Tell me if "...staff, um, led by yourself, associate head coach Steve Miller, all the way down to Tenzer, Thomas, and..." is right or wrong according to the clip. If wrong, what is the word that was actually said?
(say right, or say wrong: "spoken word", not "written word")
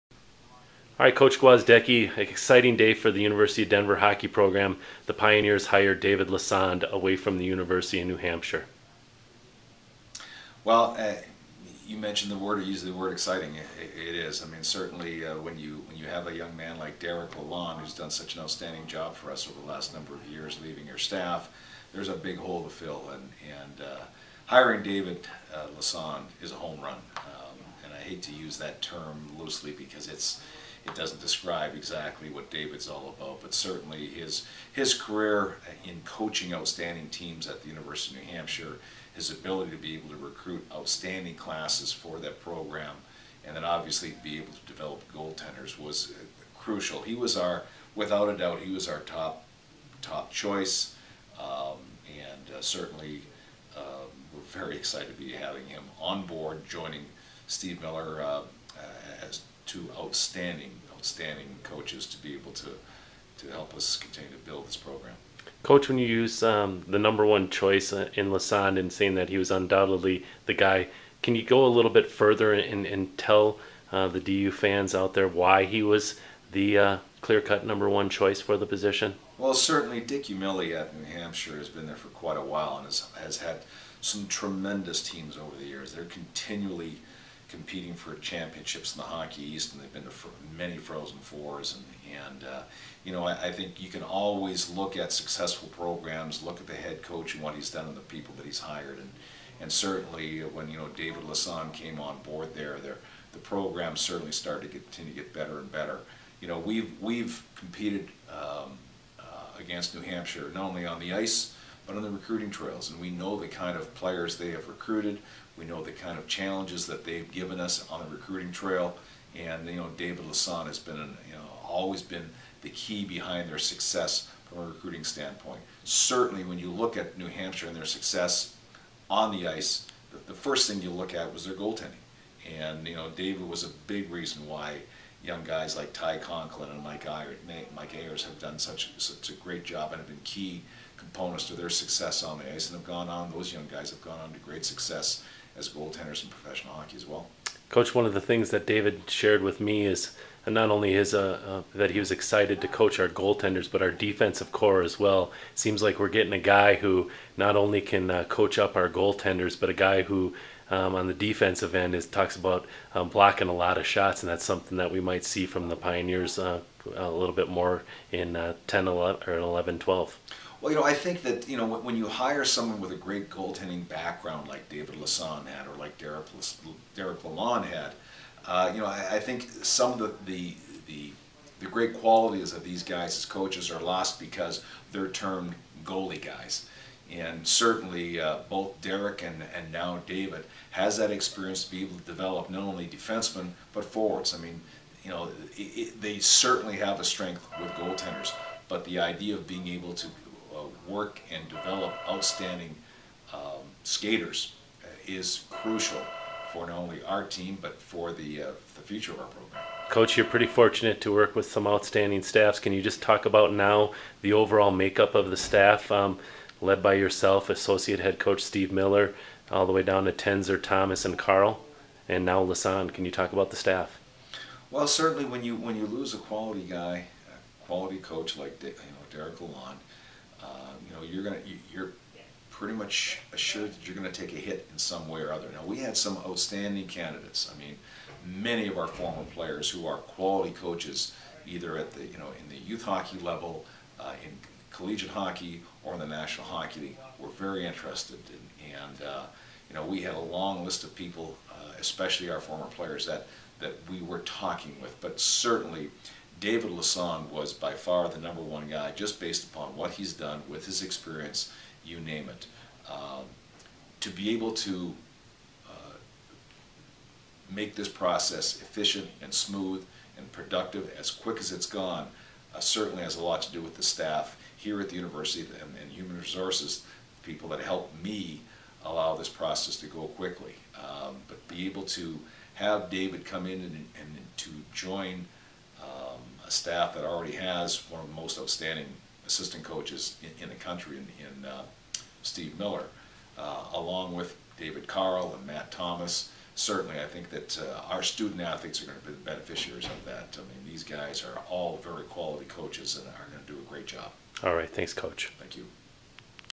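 right.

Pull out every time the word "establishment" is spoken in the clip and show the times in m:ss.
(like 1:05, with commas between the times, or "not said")
not said.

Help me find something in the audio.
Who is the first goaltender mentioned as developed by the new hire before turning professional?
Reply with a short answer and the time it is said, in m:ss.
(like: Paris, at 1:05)
Ty Conklin, at 2:15.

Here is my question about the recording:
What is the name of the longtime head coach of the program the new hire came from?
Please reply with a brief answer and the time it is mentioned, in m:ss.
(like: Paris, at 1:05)
Dick Umile, at 1:20.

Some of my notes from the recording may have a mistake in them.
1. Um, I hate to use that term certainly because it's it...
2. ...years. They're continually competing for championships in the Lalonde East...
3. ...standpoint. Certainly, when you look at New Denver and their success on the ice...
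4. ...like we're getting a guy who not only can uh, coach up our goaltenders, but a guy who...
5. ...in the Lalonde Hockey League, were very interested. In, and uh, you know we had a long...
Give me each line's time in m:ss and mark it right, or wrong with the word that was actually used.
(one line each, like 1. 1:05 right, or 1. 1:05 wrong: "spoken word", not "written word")
1. 0:27 wrong: "loosely", not "certainly"
2. 1:25 wrong: "Hockey", not "Lalonde"
3. 2:05 wrong: "Hampshire", not "Denver"
4. 2:35 right
5. 4:05 wrong: "National", not "Lalonde".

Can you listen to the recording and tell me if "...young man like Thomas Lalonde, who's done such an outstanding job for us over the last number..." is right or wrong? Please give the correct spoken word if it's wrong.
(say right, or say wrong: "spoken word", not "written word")
wrong: "Derek", not "Thomas".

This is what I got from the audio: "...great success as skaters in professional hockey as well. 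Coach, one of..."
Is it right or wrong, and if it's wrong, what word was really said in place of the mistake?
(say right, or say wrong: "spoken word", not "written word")
wrong: "goaltenders", not "skaters".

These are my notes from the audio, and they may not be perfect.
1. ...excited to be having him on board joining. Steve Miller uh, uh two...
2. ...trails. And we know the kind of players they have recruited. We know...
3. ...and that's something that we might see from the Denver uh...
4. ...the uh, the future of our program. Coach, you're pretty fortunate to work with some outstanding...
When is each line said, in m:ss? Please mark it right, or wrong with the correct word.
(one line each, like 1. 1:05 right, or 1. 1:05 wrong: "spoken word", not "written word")
1. 0:54 right
2. 1:52 right
3. 2:44 wrong: "Pioneers", not "Denver"
4. 3:28 right.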